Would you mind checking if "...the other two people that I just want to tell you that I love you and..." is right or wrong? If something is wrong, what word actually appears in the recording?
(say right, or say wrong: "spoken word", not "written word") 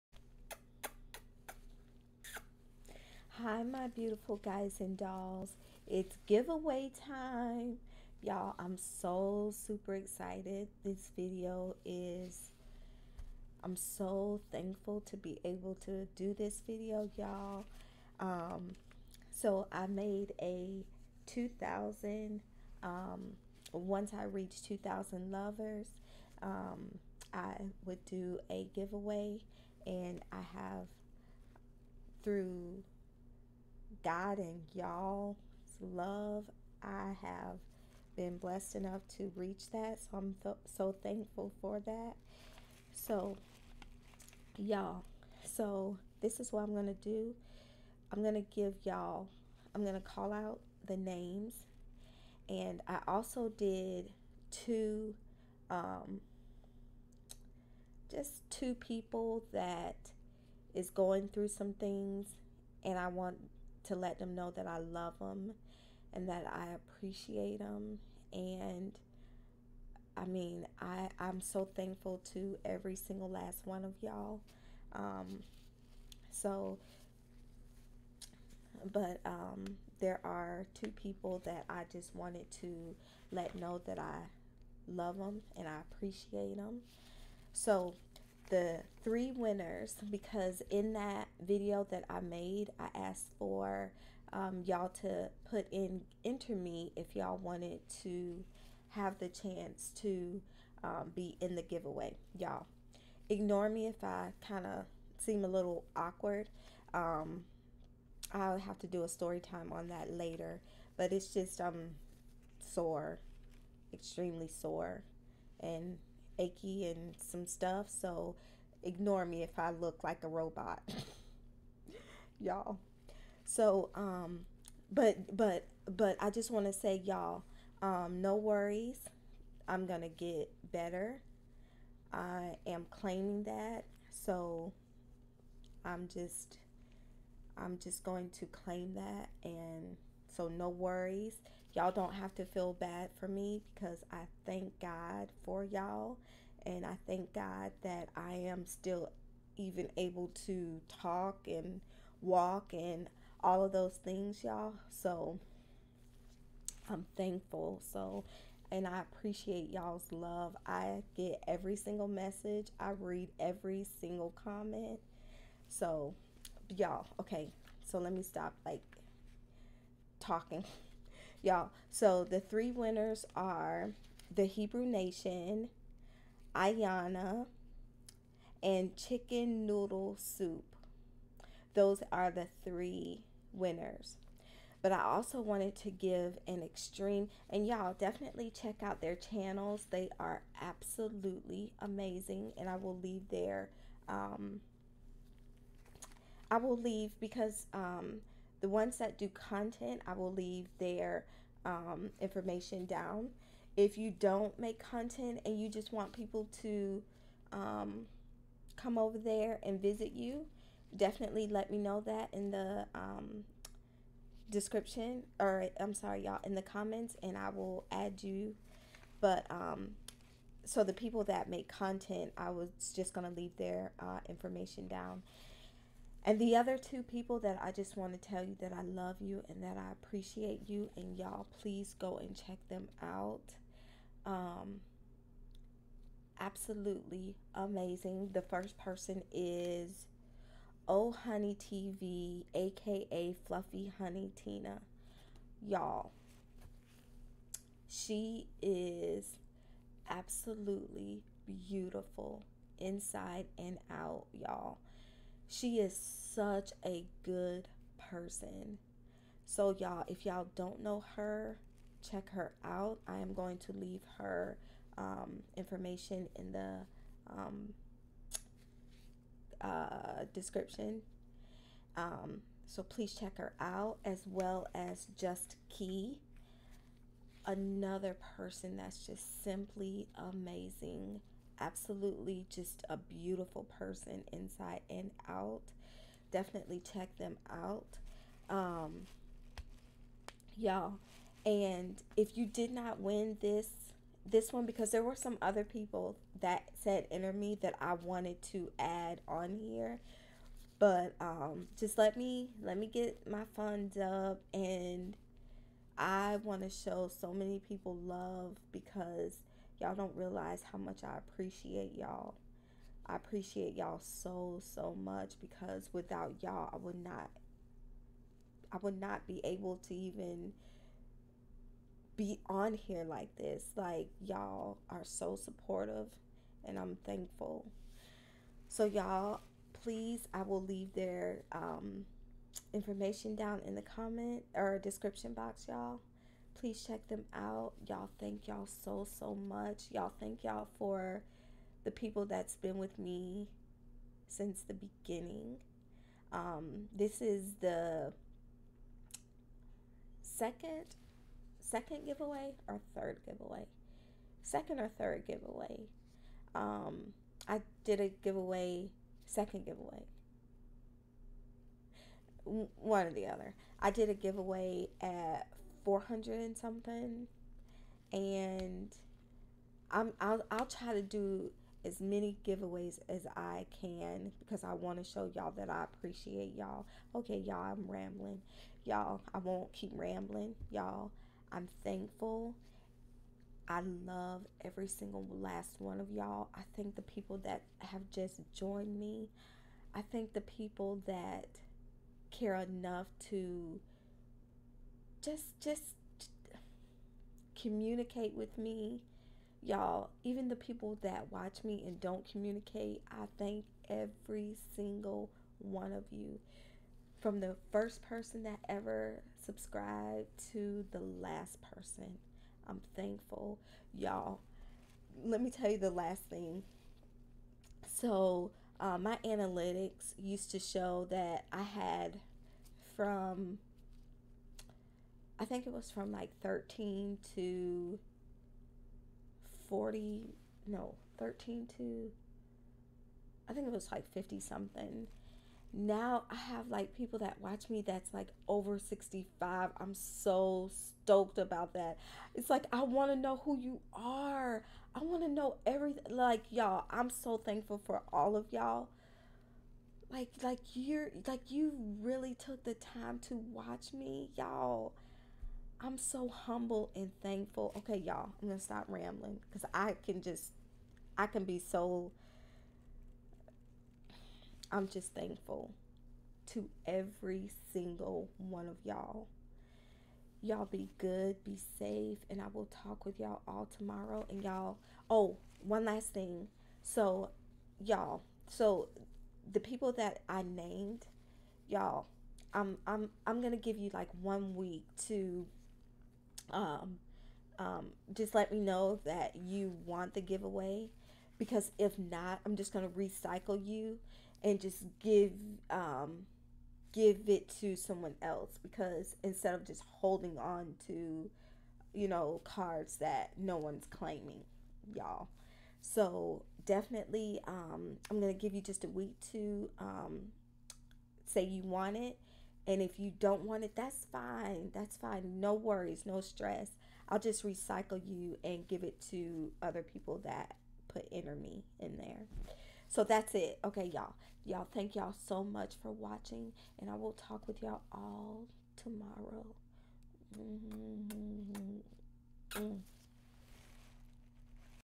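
right.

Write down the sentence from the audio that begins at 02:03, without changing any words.
So, um, but, but, but I just want to say, y'all, um, no worries.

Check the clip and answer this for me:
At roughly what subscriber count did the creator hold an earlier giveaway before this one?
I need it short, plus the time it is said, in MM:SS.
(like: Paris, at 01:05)
400 and something, at 06:05.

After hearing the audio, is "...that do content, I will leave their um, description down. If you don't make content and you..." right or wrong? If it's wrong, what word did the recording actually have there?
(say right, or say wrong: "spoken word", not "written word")
wrong: "information", not "description".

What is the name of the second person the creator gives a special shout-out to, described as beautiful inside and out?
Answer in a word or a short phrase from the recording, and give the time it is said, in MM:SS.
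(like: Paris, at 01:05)
Just Key, at 04:35.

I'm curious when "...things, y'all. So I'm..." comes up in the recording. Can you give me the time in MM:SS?
02:34.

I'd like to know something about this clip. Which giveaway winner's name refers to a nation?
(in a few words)
The Hebrew Nation.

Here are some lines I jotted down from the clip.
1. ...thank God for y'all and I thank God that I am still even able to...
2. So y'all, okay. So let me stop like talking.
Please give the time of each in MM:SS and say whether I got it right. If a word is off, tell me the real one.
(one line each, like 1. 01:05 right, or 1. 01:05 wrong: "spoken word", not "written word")
1. 02:24 right
2. 02:45 right.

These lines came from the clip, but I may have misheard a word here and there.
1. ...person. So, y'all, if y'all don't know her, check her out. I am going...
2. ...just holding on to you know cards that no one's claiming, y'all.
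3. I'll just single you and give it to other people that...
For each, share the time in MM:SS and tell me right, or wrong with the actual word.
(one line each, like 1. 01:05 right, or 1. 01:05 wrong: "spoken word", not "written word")
1. 04:17 right
2. 08:19 right
3. 08:37 wrong: "recycle", not "single".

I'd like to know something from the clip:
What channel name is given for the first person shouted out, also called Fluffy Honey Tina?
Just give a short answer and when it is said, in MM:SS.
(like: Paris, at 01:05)
Oh Honey TV, at 04:00.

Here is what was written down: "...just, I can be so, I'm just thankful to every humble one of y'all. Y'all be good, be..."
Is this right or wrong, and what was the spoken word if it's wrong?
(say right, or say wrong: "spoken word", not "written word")
wrong: "single", not "humble".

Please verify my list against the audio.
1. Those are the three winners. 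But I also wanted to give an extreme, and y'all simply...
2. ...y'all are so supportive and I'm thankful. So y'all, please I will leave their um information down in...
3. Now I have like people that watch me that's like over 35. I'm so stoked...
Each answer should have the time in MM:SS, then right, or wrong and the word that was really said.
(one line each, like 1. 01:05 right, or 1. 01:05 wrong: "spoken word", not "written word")
1. 03:01 wrong: "definitely", not "simply"
2. 05:24 right
3. 07:15 wrong: "65", not "35".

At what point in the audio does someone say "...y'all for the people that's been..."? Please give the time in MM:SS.
05:40.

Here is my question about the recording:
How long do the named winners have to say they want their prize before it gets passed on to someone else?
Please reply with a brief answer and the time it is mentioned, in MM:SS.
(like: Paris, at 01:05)
One week, at 08:04.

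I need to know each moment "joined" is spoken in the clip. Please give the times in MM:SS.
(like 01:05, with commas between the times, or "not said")
06:28.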